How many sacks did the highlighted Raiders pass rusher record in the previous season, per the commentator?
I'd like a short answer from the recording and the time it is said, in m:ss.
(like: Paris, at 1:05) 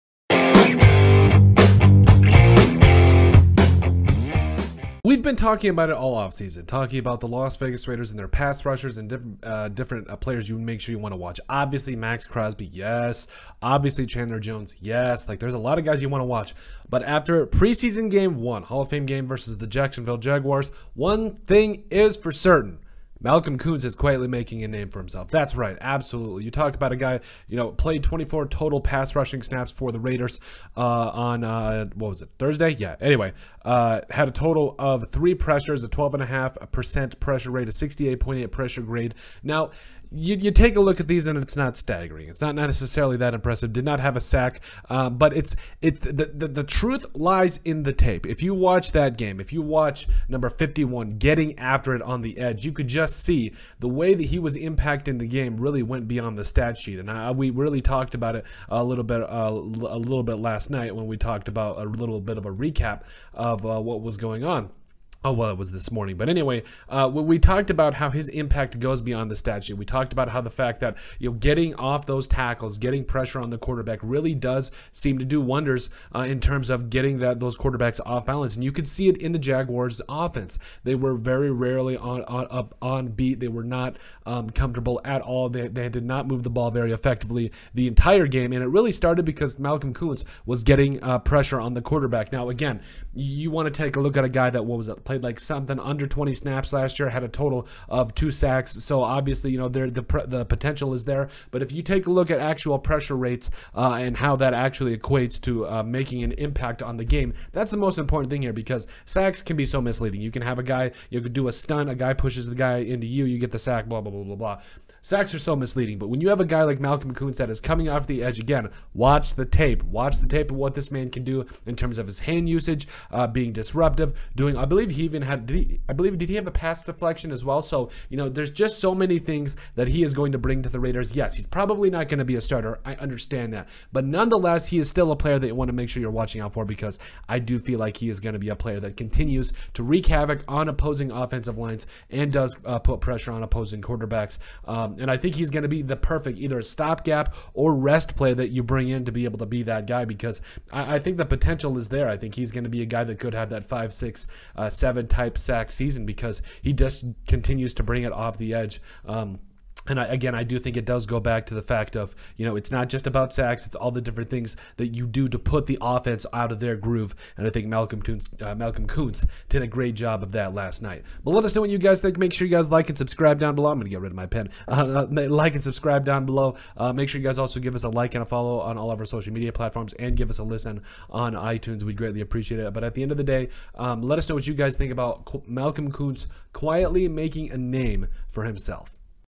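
2, at 1:38.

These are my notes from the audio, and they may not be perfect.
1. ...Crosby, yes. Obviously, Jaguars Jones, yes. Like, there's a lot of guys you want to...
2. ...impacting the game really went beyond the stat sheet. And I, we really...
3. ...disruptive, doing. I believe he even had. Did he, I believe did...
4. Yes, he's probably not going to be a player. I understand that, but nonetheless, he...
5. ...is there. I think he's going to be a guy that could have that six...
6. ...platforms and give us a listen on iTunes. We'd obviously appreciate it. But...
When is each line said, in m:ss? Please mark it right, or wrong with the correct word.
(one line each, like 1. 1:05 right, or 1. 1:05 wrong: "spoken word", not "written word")
1. 0:12 wrong: "Chandler", not "Jaguars"
2. 0:54 right
3. 2:03 right
4. 2:11 wrong: "starter", not "player"
5. 2:31 wrong: "five", not "six"
6. 2:59 wrong: "greatly", not "obviously".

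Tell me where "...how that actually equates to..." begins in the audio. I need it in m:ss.
1:44.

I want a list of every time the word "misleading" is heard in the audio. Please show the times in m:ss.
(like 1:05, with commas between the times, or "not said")
1:49, 1:55.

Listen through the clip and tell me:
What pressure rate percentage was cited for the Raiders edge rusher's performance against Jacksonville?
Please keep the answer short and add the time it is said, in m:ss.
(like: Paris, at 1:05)
12.5%, at 0:35.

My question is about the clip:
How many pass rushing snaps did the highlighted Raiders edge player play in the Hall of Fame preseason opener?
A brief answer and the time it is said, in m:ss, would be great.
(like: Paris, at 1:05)
24, at 0:28.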